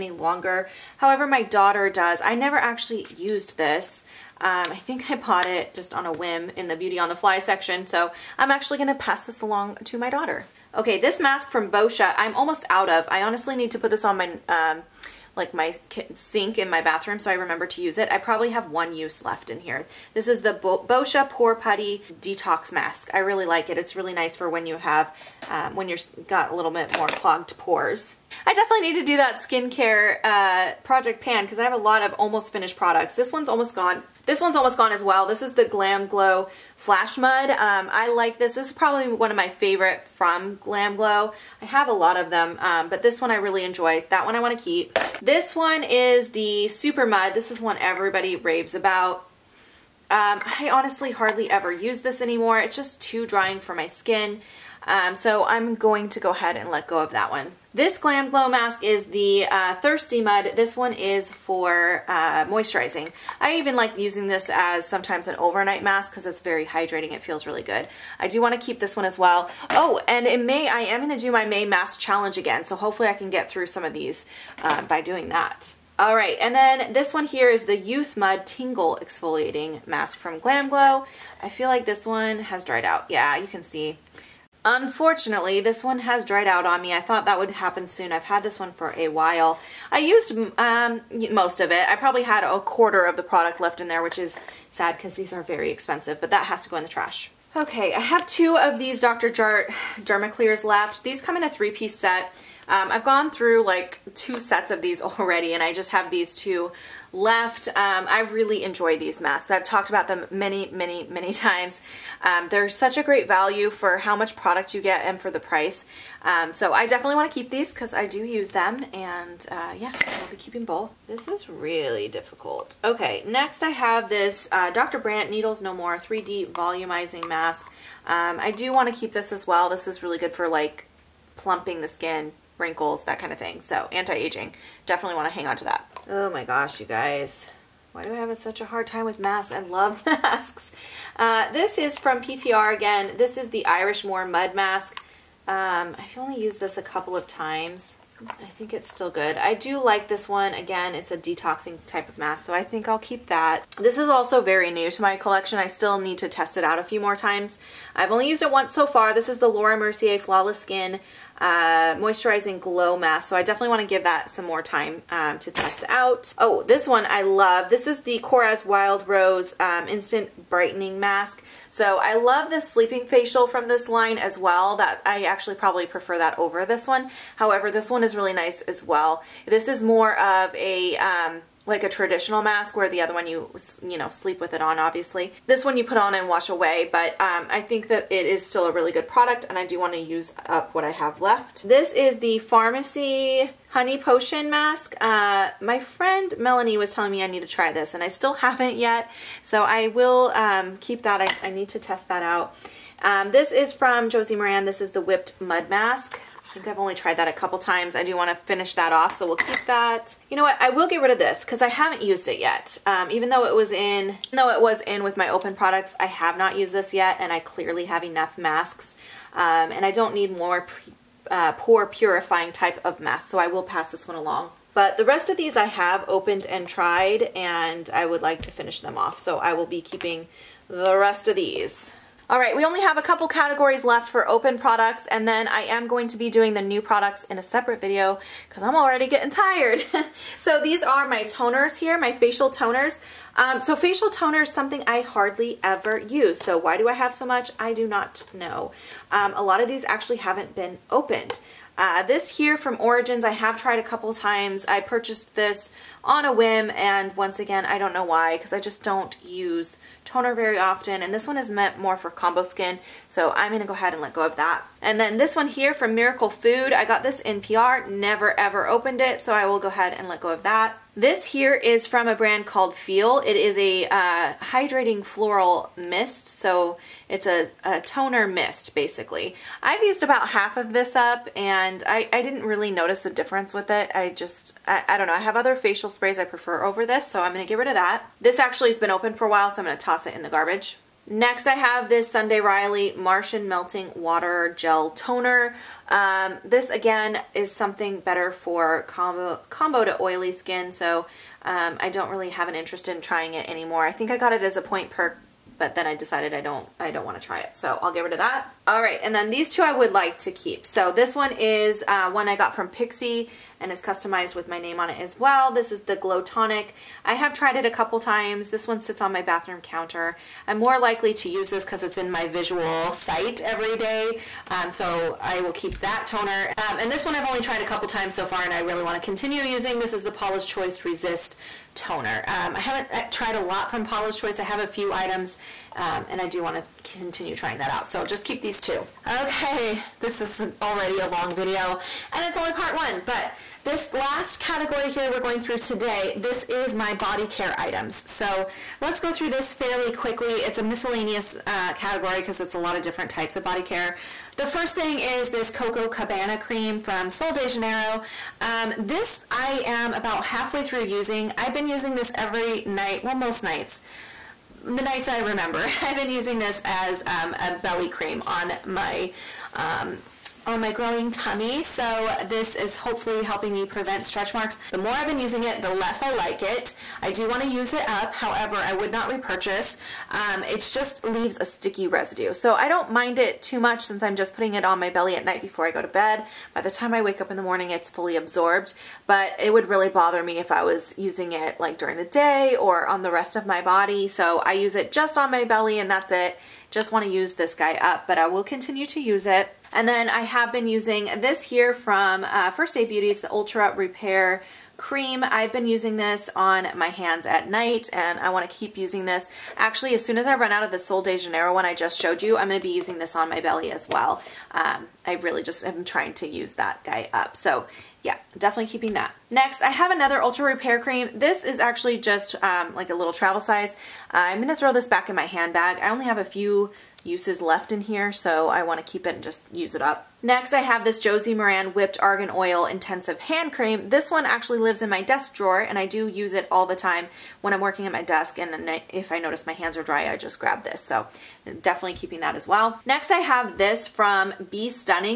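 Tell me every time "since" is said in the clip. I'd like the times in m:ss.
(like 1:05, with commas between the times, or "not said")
6:23.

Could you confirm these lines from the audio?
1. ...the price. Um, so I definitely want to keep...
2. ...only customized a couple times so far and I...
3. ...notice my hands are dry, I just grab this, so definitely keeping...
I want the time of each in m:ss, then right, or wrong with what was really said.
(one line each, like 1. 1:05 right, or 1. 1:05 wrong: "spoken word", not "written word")
1. 1:55 right
2. 5:27 wrong: "tried", not "customized"
3. 7:19 right.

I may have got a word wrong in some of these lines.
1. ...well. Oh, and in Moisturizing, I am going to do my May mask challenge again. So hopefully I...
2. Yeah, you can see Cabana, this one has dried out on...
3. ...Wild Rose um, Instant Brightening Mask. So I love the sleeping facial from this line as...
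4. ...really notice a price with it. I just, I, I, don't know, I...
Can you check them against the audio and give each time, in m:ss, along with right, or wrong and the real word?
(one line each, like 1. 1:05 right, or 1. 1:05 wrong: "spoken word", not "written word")
1. 1:09 wrong: "May", not "Moisturizing"
2. 1:23 wrong: "Unfortunately", not "Cabana"
3. 2:48 right
4. 4:42 wrong: "difference", not "price".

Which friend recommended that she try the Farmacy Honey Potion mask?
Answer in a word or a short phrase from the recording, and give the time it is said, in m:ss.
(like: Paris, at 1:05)
Melanie, at 3:16.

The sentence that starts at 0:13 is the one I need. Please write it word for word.
I honestly need to put this on my um, like my sink in my bathroom so I remember to use it.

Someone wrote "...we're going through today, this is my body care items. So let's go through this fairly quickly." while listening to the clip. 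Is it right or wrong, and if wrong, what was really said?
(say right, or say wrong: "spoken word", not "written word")
right.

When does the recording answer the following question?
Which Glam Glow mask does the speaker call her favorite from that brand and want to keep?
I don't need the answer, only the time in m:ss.
0:36.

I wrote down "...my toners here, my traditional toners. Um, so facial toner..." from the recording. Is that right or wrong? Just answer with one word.
wrong.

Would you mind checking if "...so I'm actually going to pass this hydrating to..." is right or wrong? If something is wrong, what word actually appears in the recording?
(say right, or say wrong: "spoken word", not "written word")
wrong: "along", not "hydrating".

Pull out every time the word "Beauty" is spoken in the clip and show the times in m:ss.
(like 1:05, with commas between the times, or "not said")
0:06, 6:42.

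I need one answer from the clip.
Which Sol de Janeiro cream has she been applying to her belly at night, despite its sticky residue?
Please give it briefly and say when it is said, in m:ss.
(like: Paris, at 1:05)
Coco Cabana, at 5:55.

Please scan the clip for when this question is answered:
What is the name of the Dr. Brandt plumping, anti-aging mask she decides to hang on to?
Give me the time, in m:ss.
2:05.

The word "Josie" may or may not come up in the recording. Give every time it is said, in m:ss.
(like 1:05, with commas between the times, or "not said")
3:24, 7:11.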